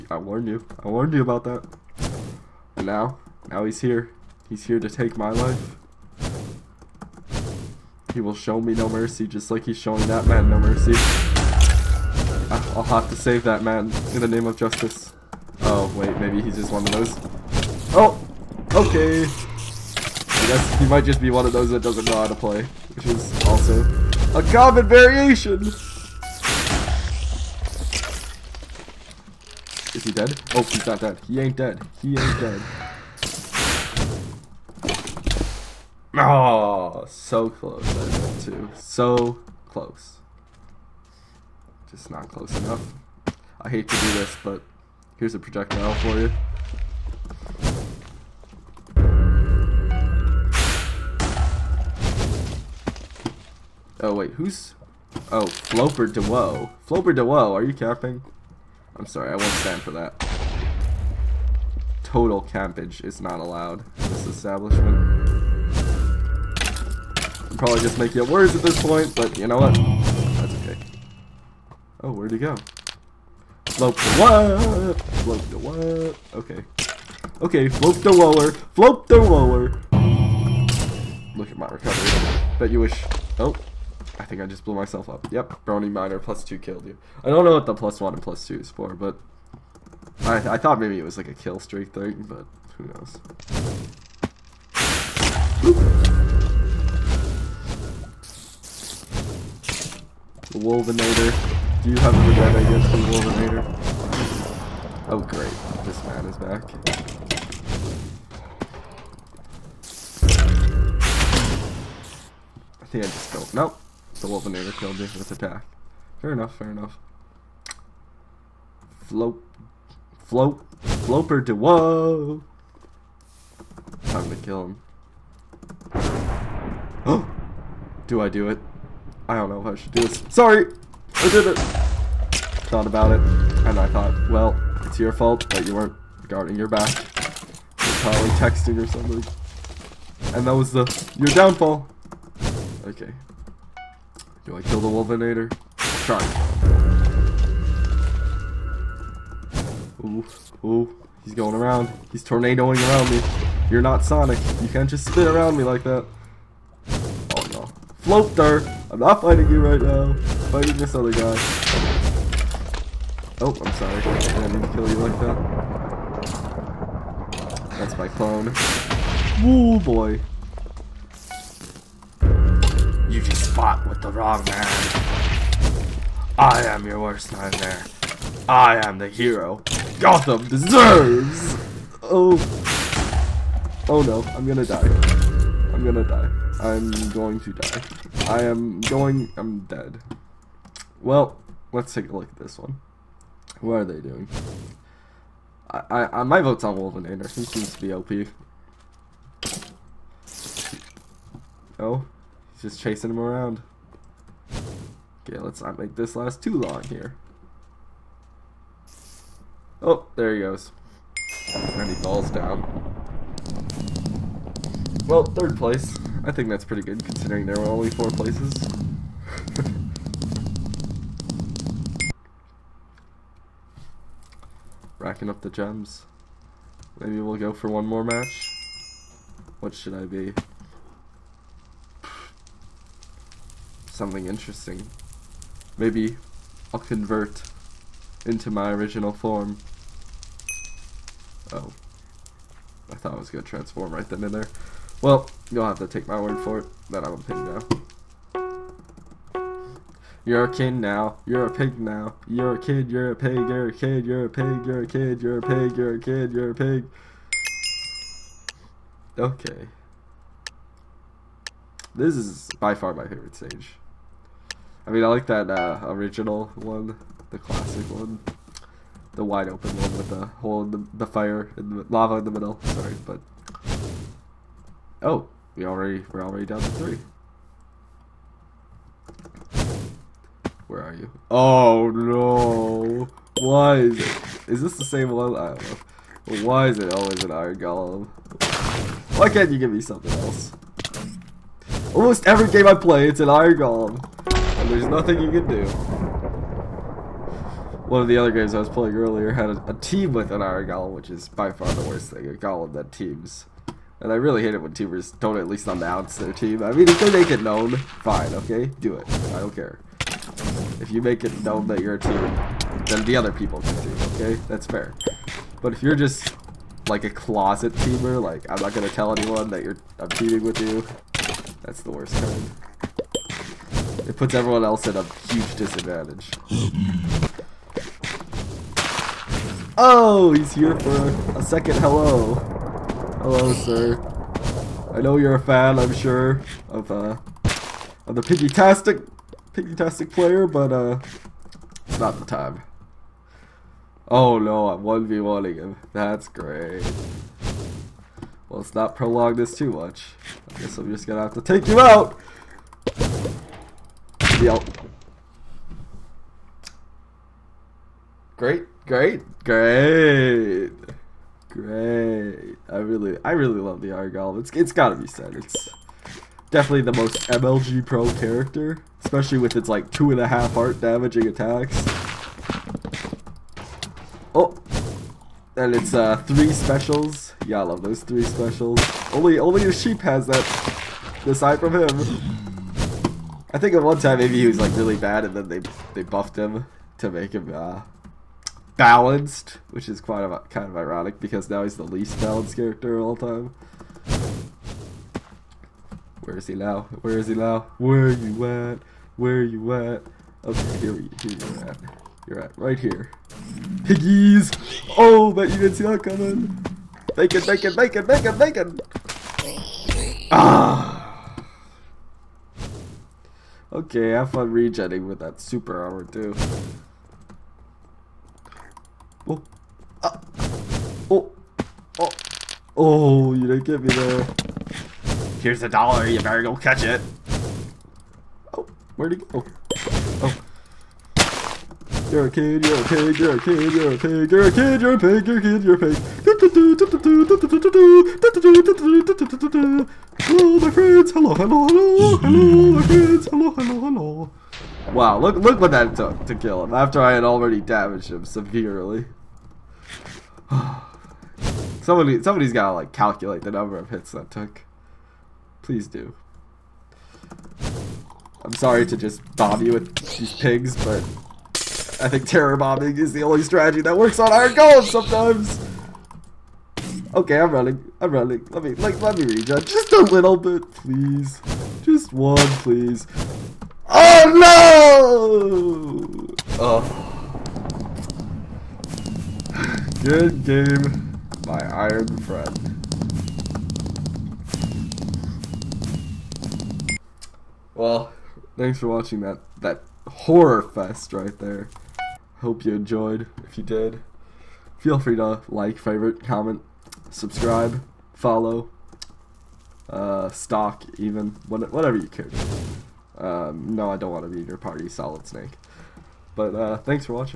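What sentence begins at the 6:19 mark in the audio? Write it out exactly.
Only, only the sheep has that.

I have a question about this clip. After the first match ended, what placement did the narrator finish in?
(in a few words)
Third place.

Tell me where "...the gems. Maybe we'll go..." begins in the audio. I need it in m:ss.
3:45.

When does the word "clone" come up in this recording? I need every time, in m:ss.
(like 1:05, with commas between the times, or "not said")
2:48.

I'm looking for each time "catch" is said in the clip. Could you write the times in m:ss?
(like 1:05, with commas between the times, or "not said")
7:06.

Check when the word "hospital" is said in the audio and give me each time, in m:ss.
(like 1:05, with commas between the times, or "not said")
not said.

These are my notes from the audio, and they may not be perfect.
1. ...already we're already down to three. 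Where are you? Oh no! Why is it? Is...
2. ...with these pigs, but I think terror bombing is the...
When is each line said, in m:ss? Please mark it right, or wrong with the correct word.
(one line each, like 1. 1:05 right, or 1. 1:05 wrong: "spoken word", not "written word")
1. 4:35 right
2. 7:39 right.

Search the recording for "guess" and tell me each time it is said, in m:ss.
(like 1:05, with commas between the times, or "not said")
0:20, 5:50.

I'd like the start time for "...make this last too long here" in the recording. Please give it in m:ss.
3:25.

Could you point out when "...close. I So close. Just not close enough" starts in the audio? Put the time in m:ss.
0:37.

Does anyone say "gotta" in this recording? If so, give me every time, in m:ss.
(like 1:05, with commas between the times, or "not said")
6:04, 7:32.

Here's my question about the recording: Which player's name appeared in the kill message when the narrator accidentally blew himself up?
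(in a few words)
BronyMiner.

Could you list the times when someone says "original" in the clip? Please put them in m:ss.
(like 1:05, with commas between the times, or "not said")
3:58, 4:25.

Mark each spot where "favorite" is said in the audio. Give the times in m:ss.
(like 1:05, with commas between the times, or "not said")
4:23, 8:15.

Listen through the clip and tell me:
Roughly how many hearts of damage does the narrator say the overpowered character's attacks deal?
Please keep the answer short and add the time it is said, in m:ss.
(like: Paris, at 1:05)
2.5, at 6:09.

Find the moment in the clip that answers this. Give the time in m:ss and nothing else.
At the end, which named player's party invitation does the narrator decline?
8:24.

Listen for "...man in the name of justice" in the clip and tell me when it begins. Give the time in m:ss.
0:13.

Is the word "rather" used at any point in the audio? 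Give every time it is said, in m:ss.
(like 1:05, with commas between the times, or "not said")
not said.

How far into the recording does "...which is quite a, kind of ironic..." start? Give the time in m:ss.
6:29.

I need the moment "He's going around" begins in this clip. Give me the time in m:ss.
2:31.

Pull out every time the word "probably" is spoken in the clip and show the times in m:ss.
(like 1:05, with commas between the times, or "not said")
1:07, 2:18.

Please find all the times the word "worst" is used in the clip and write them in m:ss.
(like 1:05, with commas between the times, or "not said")
2:56, 5:01, 5:21.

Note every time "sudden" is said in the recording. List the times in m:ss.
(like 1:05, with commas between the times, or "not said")
not said.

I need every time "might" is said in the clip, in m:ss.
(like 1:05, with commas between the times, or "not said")
0:20.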